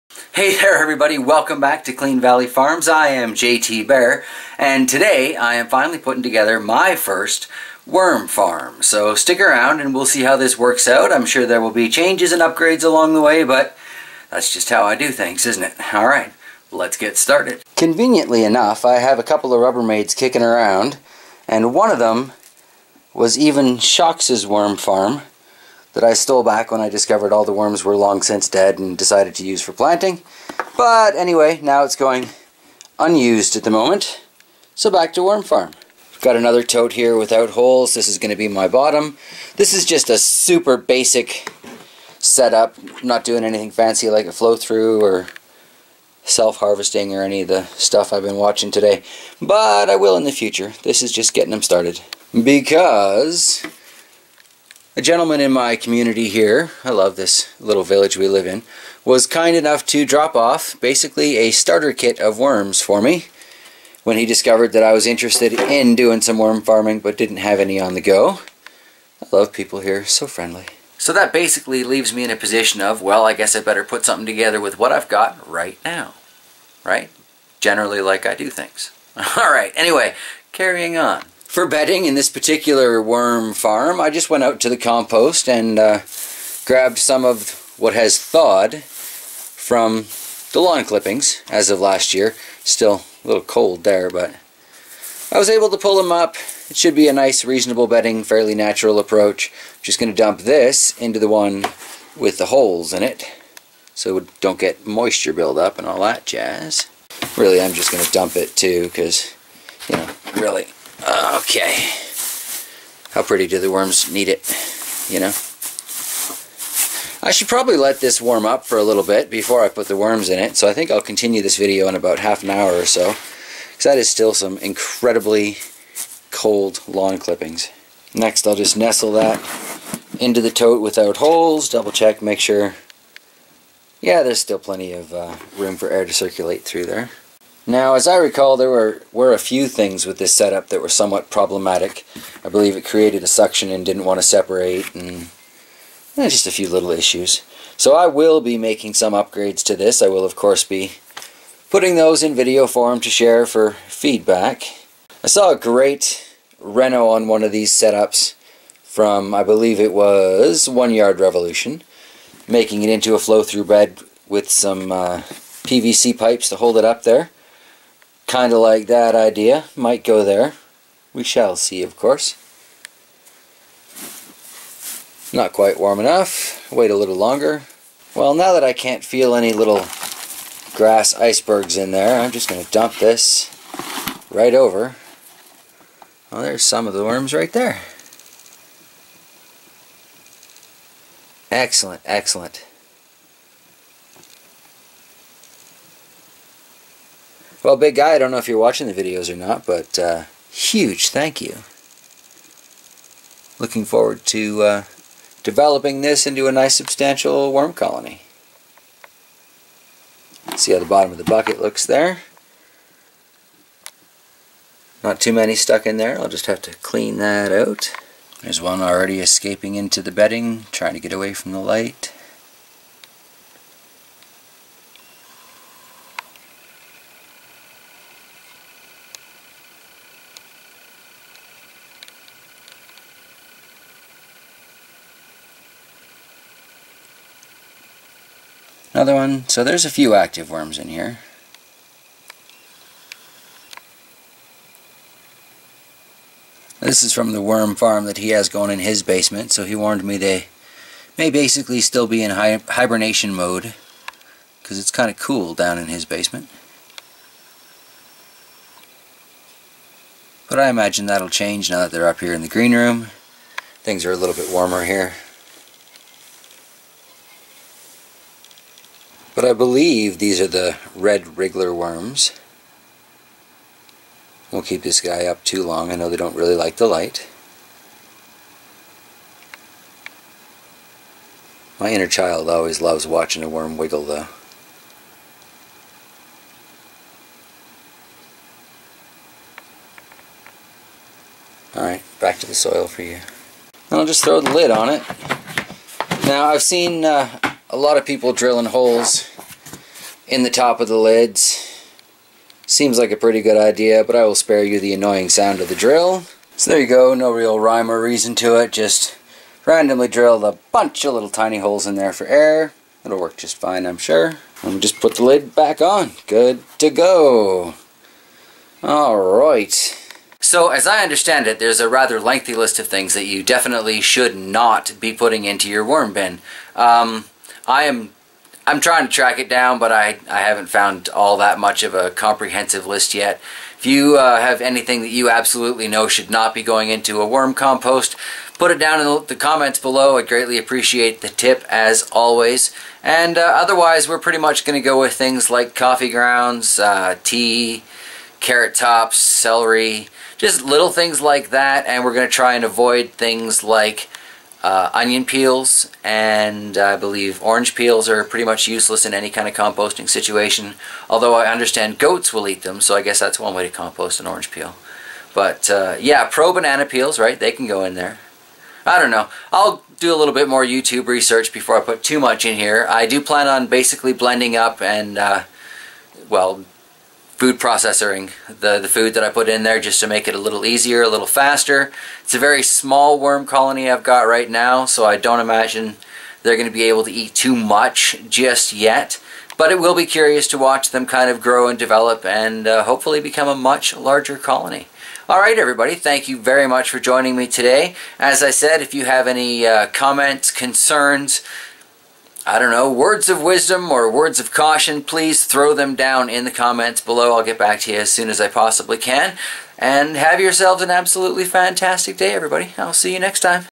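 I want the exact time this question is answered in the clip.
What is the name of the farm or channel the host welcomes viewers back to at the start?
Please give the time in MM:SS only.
00:01.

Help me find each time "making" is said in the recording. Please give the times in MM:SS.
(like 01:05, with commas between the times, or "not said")
02:28, 02:42.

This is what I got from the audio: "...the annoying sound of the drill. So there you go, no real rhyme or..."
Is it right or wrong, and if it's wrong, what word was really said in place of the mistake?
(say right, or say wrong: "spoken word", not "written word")
right.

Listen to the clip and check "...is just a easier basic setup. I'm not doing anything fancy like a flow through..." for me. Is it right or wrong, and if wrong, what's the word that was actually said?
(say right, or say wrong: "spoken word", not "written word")
wrong: "super", not "easier".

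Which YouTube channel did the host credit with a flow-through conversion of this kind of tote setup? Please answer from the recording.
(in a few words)
One Yard Revolution.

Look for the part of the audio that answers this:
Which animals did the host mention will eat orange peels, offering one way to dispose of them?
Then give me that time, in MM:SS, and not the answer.
06:01.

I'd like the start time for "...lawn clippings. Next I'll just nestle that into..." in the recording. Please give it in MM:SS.
02:06.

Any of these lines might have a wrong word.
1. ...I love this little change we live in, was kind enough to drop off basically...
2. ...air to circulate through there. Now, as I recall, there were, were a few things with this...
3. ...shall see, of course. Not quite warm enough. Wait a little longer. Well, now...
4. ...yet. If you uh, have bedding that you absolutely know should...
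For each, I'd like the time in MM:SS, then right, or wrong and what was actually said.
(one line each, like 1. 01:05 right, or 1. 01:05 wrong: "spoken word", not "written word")
1. 00:56 wrong: "village", not "change"
2. 02:15 right
3. 02:51 right
4. 05:33 wrong: "anything", not "bedding".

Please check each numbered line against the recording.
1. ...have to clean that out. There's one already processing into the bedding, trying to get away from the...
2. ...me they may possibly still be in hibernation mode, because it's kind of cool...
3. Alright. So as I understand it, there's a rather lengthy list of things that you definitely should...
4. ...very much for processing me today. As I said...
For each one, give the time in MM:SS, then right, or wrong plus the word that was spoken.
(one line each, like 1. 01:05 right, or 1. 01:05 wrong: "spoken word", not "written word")
1. 03:36 wrong: "escaping", not "processing"
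2. 04:10 wrong: "basically", not "possibly"
3. 05:18 right
4. 06:36 wrong: "joining", not "processing".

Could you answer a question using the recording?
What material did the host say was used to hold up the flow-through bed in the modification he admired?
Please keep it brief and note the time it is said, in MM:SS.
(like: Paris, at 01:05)
PVC pipes, at 02:45.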